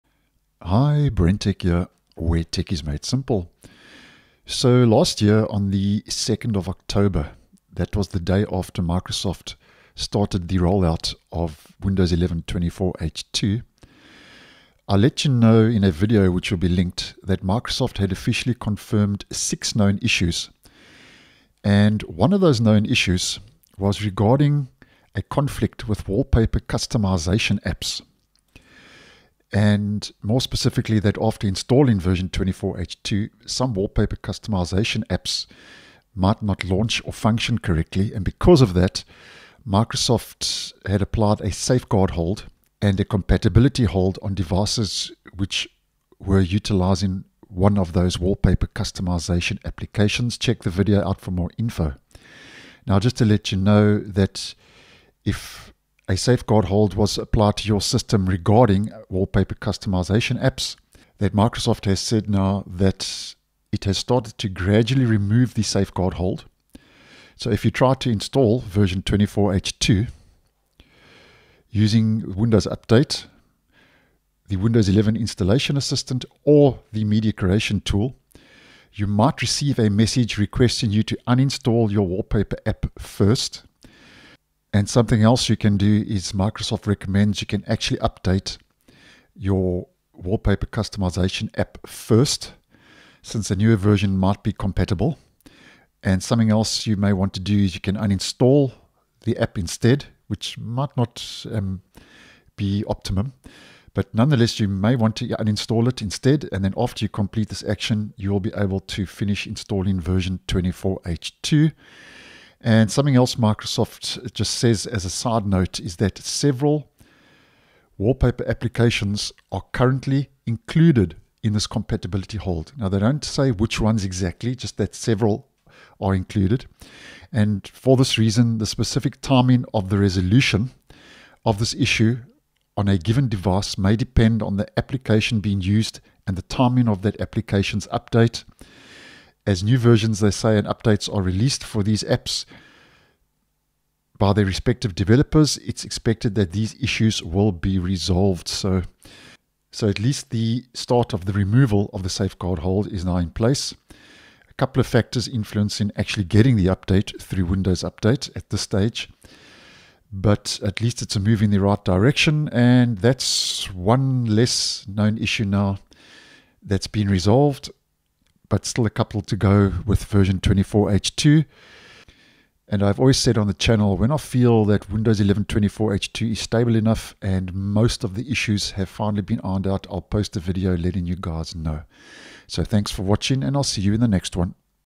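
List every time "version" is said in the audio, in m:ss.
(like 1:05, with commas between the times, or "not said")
0:31, 1:08, 1:33, 1:49, 2:19, 2:50.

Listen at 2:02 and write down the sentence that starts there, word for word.
Now, they don't say which ones exactly, just that several are included.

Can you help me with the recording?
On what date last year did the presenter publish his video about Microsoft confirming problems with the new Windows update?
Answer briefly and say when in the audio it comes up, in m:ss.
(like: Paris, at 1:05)
2nd of October, at 0:06.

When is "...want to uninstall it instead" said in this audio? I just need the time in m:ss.
1:44.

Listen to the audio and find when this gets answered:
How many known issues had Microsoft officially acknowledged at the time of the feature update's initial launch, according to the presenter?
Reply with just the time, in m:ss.
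0:19.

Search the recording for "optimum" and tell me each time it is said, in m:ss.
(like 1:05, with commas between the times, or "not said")
1:42.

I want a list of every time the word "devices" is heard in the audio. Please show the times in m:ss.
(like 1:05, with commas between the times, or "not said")
0:44, 2:13.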